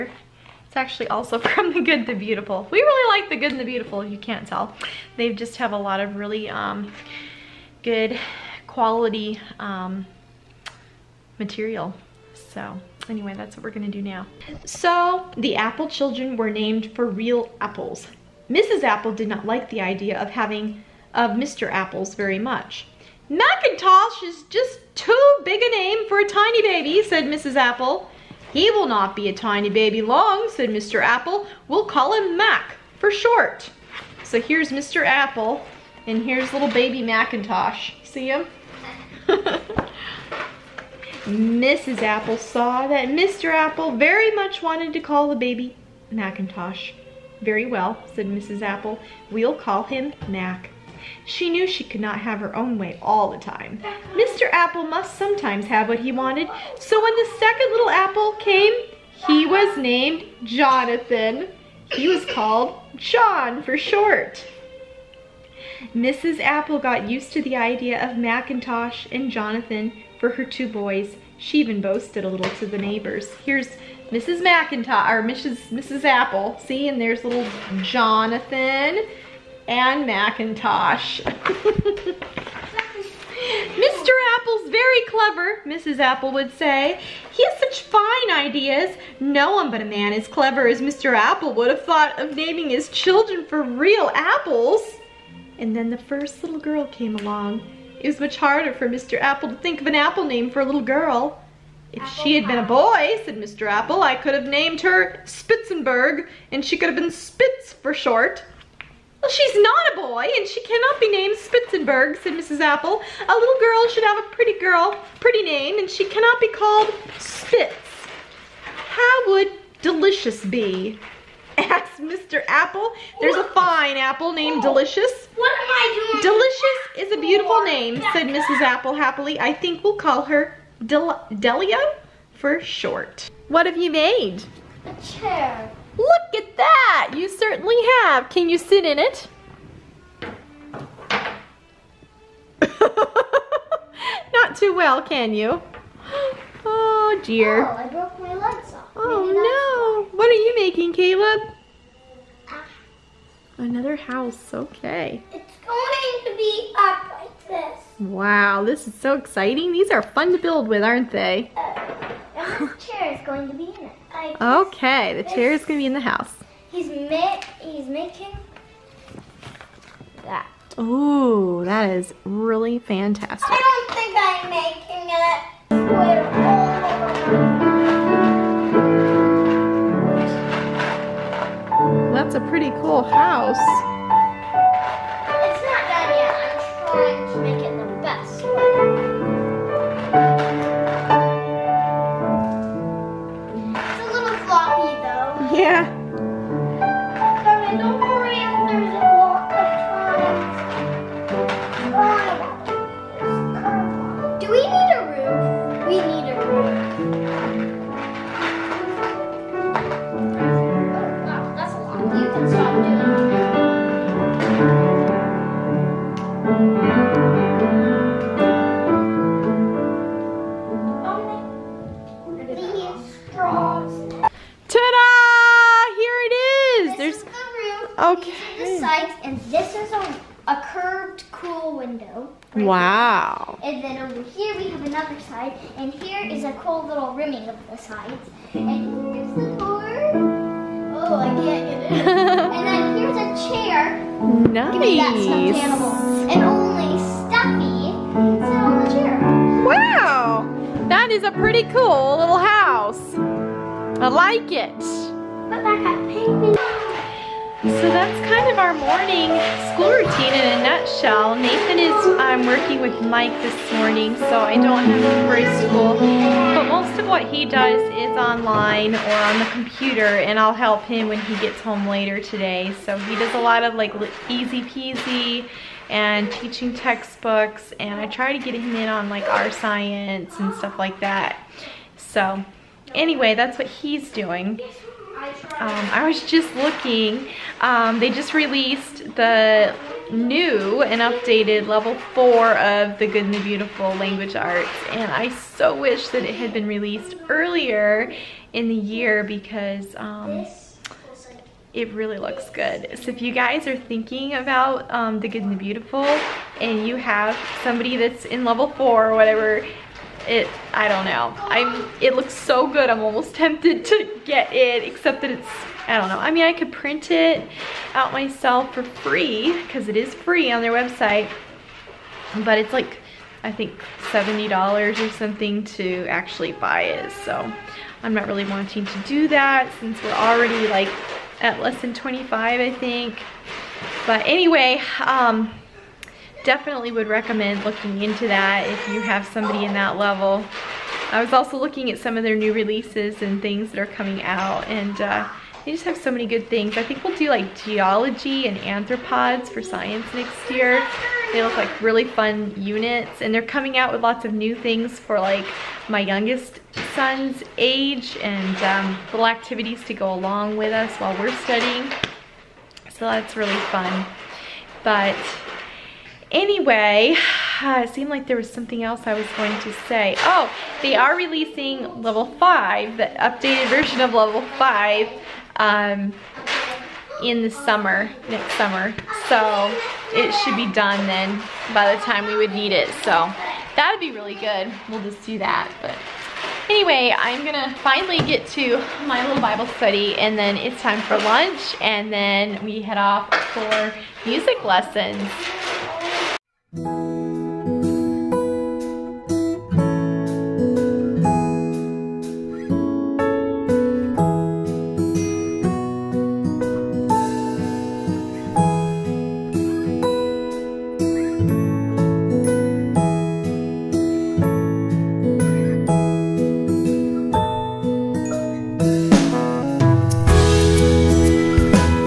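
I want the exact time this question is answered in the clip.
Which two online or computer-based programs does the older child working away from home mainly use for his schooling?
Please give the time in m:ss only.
4:34.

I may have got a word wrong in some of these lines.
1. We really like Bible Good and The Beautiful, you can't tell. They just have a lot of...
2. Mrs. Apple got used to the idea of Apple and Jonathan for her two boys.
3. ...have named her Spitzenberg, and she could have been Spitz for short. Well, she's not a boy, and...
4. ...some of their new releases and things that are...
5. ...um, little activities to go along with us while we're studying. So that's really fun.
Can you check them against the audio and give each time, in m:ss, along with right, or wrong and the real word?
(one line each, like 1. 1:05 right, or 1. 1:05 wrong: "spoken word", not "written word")
1. 0:02 wrong: "The", not "Bible"
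2. 1:05 wrong: "Macintosh", not "Apple"
3. 1:44 right
4. 5:41 right
5. 5:58 right.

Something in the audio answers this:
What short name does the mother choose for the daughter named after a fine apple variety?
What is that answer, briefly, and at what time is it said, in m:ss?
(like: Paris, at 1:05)
Delia, at 2:11.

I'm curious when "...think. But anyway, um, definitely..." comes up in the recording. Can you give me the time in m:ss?
5:32.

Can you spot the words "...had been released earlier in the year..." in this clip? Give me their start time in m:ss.
4:56.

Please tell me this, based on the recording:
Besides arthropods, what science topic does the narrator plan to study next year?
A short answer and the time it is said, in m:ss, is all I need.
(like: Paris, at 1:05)
geology, at 5:47.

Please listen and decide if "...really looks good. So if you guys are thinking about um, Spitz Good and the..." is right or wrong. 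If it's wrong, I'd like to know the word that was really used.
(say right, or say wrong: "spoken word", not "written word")
wrong: "The", not "Spitz".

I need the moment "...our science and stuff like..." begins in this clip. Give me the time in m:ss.
4:39.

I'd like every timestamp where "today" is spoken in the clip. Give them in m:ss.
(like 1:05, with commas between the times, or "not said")
4:32.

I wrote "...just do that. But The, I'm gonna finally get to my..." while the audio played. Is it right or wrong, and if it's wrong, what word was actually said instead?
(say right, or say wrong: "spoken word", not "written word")
wrong: "Anyway", not "The".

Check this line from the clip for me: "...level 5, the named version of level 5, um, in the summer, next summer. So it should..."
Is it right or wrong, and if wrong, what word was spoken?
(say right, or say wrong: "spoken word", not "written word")
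wrong: "updated", not "named".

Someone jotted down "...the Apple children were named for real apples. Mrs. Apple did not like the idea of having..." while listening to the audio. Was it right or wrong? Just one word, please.
right.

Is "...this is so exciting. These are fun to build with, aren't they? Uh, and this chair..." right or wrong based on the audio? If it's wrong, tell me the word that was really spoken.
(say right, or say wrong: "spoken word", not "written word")
right.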